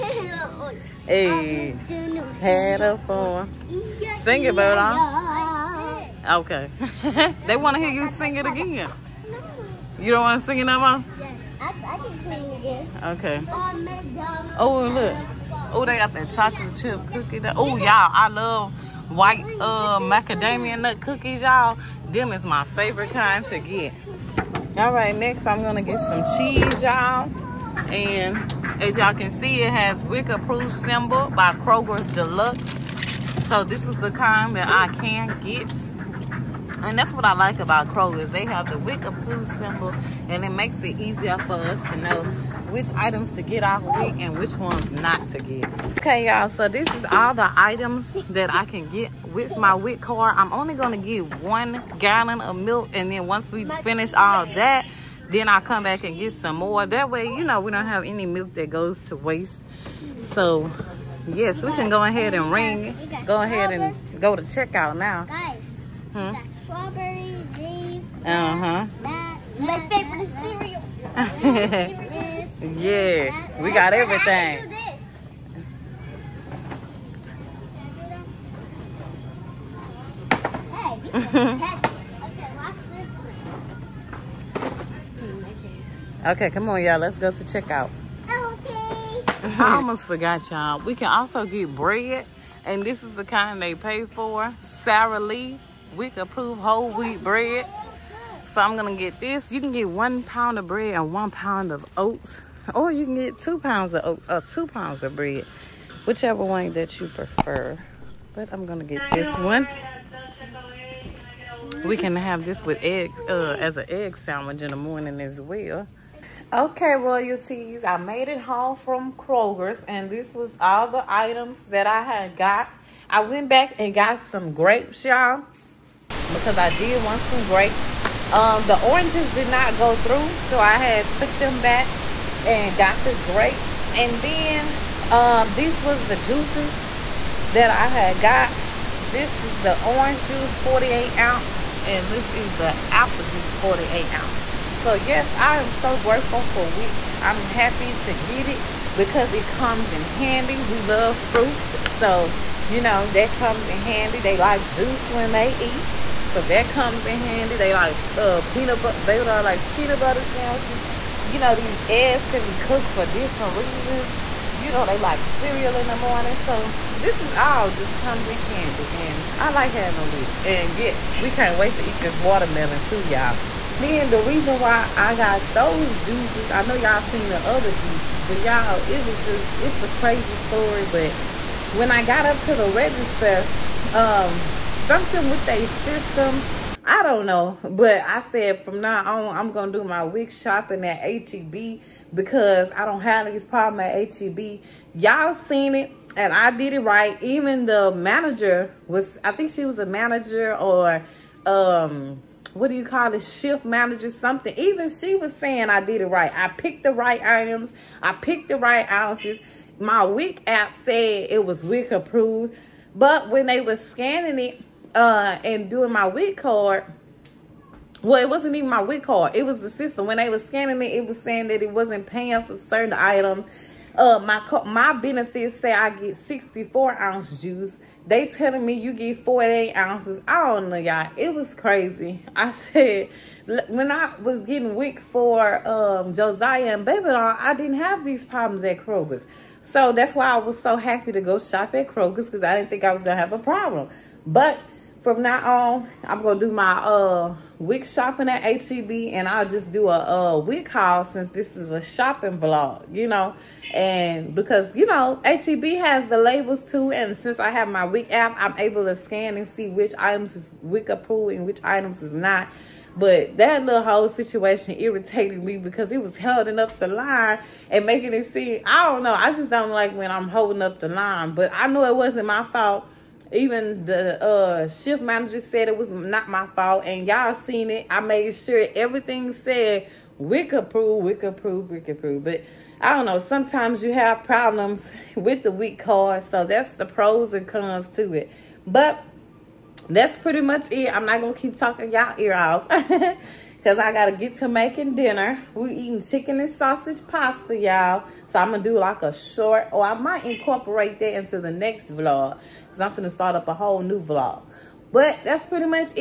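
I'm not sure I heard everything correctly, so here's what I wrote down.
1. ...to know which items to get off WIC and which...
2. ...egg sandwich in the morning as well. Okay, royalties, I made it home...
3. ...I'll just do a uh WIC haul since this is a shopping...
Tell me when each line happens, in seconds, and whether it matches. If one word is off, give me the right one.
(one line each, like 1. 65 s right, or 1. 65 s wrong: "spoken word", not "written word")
1. 41 s right
2. 113 s right
3. 249 s right.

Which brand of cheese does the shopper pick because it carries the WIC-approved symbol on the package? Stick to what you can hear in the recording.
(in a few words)
Kroger's Deluxe.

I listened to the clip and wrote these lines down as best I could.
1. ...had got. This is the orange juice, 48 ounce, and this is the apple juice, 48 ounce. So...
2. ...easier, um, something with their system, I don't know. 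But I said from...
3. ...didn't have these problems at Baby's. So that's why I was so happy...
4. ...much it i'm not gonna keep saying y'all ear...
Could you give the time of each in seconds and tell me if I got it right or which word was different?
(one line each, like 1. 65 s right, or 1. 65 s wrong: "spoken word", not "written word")
1. 137 s right
2. 182 s wrong: "register", not "easier"
3. 237 s wrong: "Kroger", not "Baby"
4. 290 s wrong: "talking", not "saying".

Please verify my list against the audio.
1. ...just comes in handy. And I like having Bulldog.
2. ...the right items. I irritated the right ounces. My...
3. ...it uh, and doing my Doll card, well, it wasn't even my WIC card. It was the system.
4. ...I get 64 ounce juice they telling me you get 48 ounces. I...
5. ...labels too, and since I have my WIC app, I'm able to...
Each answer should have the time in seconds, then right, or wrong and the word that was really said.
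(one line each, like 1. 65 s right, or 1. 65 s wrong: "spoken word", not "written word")
1. 167 s wrong: "WIC", not "Bulldog"
2. 206 s wrong: "picked", not "irritated"
3. 214 s wrong: "WIC", not "Doll"
4. 225 s right
5. 256 s right.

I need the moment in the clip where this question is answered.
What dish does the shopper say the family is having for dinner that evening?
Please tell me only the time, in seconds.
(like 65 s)
296 s.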